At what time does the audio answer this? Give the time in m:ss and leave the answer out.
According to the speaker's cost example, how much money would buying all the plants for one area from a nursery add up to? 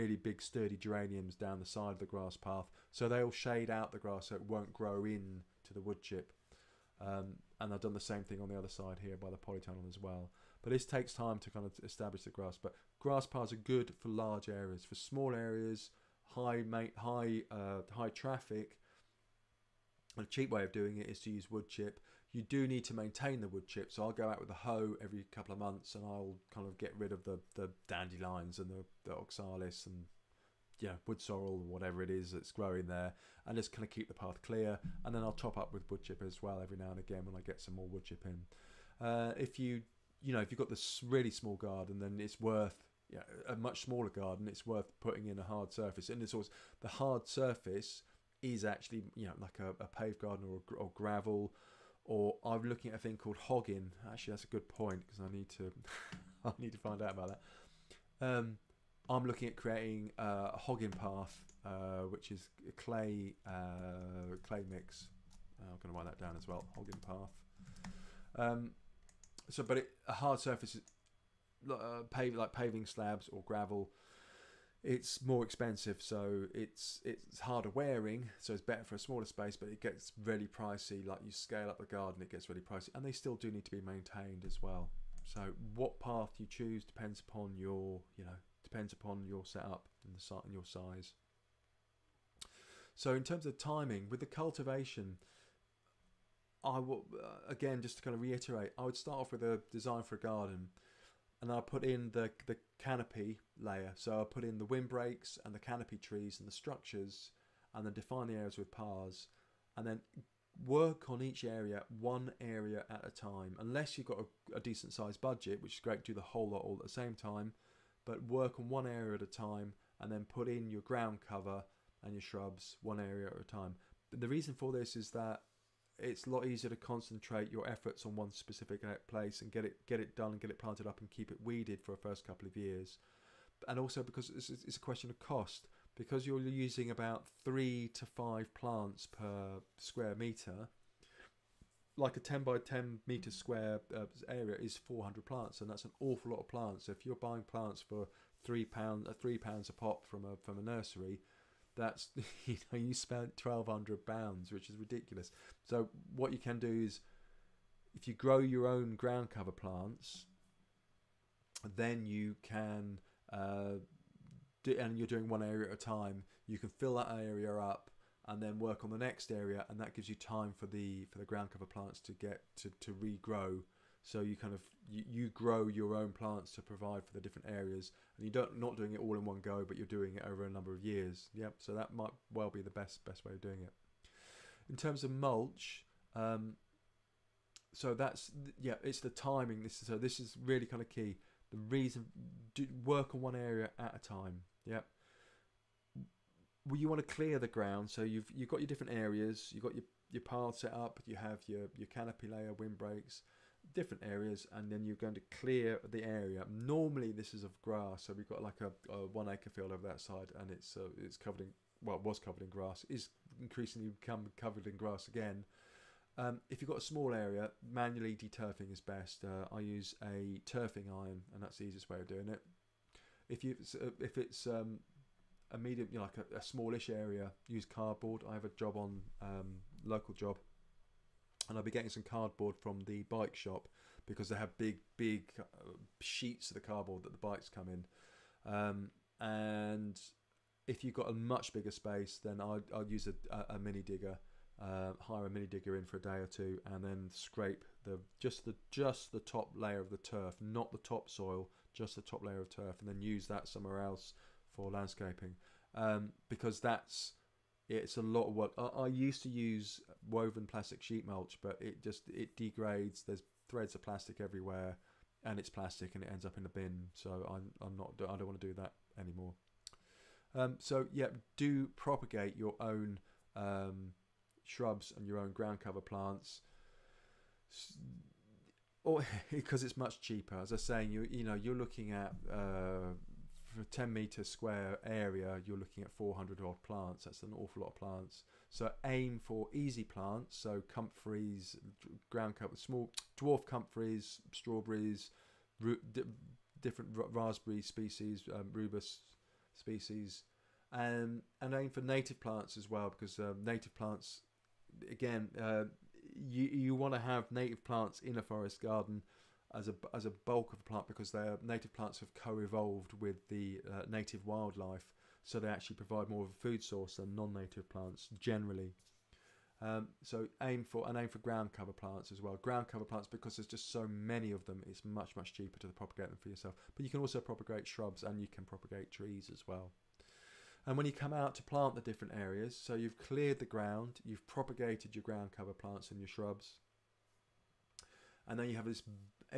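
2:33.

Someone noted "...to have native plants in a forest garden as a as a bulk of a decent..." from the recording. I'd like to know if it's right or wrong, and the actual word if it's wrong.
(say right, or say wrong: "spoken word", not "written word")
wrong: "plant", not "decent".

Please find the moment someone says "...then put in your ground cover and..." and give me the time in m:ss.
2:00.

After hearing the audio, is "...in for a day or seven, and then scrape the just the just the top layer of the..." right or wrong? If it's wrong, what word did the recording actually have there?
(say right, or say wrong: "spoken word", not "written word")
wrong: "two", not "seven".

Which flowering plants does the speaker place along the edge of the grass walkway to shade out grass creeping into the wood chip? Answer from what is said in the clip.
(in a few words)
geraniums.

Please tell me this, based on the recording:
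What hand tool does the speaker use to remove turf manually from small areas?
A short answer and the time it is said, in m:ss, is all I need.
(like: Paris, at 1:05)
turfing iron, at 3:40.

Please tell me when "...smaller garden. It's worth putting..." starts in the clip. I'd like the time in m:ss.
0:43.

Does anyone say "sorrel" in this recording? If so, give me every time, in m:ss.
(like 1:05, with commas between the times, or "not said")
0:31.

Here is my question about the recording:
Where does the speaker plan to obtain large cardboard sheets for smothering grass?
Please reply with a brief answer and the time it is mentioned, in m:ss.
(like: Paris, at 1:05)
the bike shop, at 3:52.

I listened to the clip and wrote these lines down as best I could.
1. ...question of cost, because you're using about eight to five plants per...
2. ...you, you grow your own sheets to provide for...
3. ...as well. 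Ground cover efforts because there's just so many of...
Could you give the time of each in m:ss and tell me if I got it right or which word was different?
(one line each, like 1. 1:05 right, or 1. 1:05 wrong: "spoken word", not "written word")
1. 2:14 wrong: "three", not "eight"
2. 2:54 wrong: "plants", not "sheets"
3. 5:22 wrong: "plants", not "efforts".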